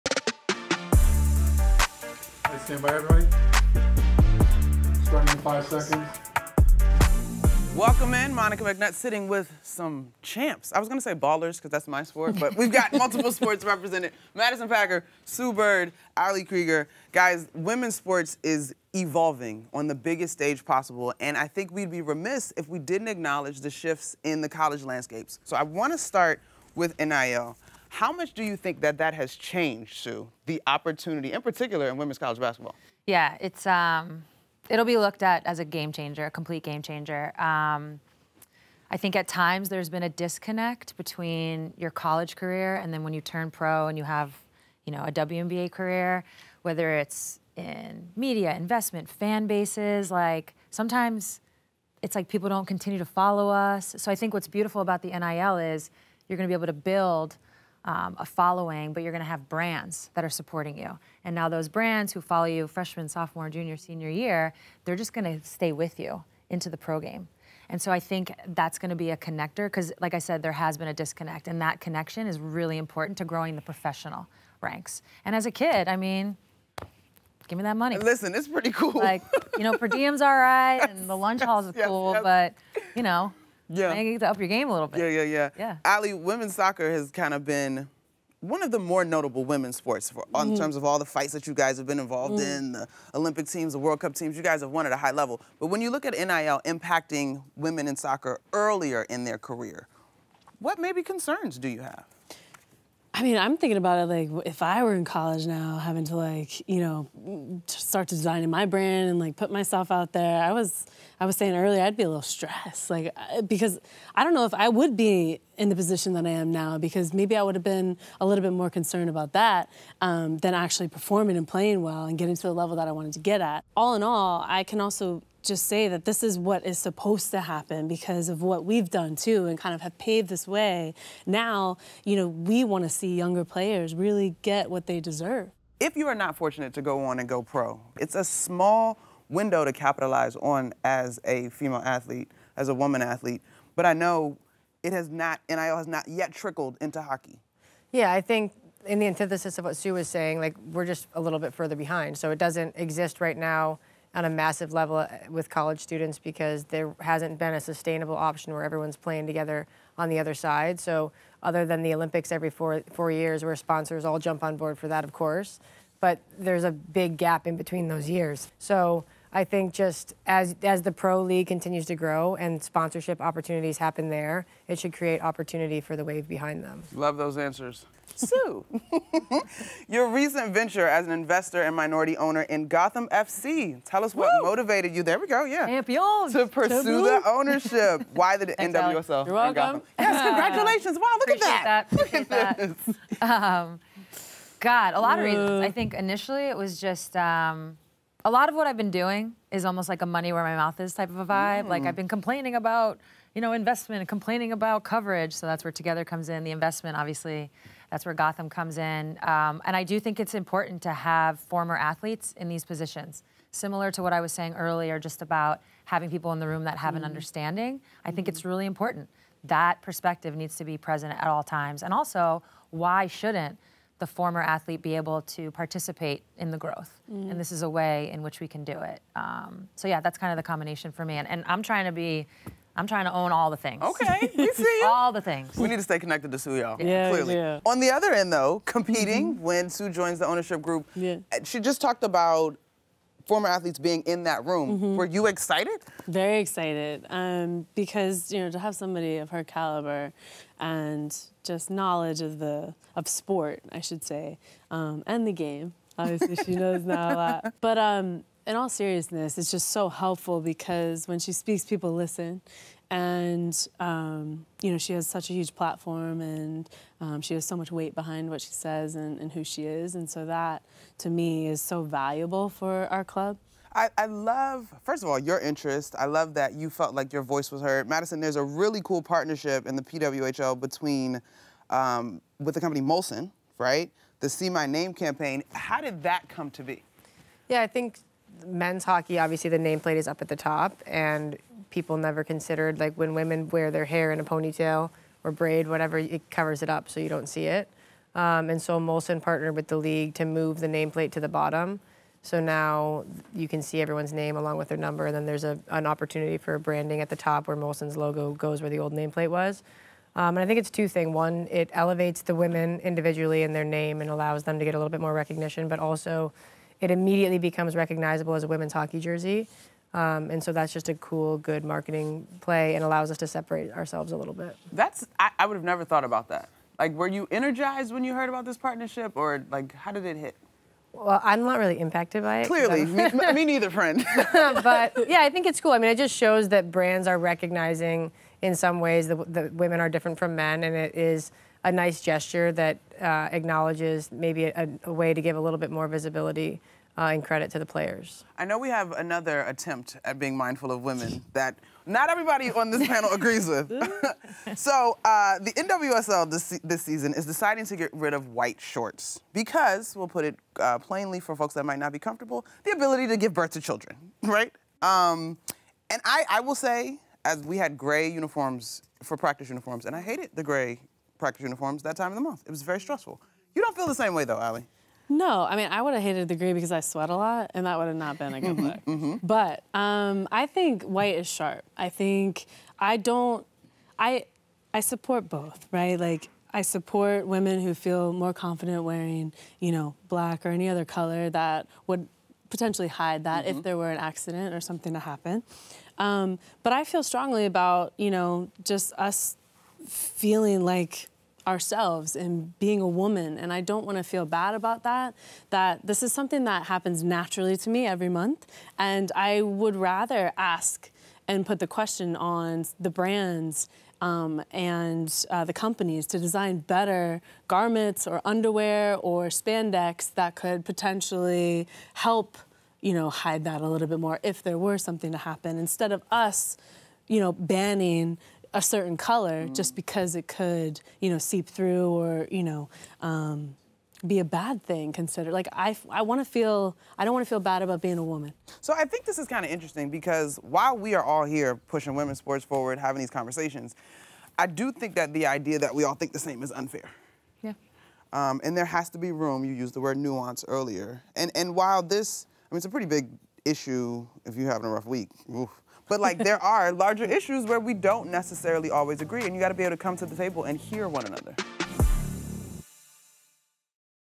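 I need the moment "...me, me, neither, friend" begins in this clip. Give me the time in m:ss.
5:32.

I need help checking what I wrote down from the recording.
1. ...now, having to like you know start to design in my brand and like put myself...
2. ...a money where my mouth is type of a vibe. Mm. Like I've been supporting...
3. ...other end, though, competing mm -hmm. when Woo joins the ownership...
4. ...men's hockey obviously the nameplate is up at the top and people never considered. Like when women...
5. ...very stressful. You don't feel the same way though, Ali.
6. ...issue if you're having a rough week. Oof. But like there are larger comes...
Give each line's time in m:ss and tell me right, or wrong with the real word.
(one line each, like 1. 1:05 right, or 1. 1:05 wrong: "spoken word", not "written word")
1. 1:45 right
2. 3:20 wrong: "complaining", not "supporting"
3. 3:57 wrong: "Sue", not "Woo"
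4. 4:48 right
5. 6:12 right
6. 7:33 wrong: "issues", not "comes".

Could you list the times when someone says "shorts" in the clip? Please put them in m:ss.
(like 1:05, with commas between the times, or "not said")
5:58.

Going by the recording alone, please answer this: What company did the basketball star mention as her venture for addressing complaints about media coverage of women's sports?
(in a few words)
Togethxr.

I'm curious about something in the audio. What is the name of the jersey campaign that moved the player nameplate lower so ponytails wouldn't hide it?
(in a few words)
See My Name.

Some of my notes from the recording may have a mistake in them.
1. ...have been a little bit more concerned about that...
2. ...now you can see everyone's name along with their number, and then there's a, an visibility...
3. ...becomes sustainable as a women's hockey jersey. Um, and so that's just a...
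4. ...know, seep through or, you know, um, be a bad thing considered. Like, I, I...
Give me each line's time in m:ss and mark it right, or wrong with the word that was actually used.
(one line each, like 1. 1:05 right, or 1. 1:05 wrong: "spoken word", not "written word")
1. 1:57 right
2. 5:02 wrong: "opportunity", not "visibility"
3. 5:17 wrong: "recognizable", not "sustainable"
4. 7:11 right.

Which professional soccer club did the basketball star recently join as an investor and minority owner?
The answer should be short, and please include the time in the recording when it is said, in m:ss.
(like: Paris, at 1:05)
Gotham FC, at 3:02.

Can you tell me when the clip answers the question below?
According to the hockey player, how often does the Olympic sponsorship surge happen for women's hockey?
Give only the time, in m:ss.
2:42.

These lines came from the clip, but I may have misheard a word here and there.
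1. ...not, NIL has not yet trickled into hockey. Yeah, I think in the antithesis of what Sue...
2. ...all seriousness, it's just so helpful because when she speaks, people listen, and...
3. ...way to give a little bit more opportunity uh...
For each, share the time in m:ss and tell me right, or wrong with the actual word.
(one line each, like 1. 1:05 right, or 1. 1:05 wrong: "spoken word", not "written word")
1. 2:25 right
2. 4:18 right
3. 5:44 wrong: "visibility", not "opportunity".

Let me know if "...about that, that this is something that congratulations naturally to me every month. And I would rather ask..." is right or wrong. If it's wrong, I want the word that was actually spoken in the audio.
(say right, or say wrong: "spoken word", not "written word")
wrong: "happens", not "congratulations".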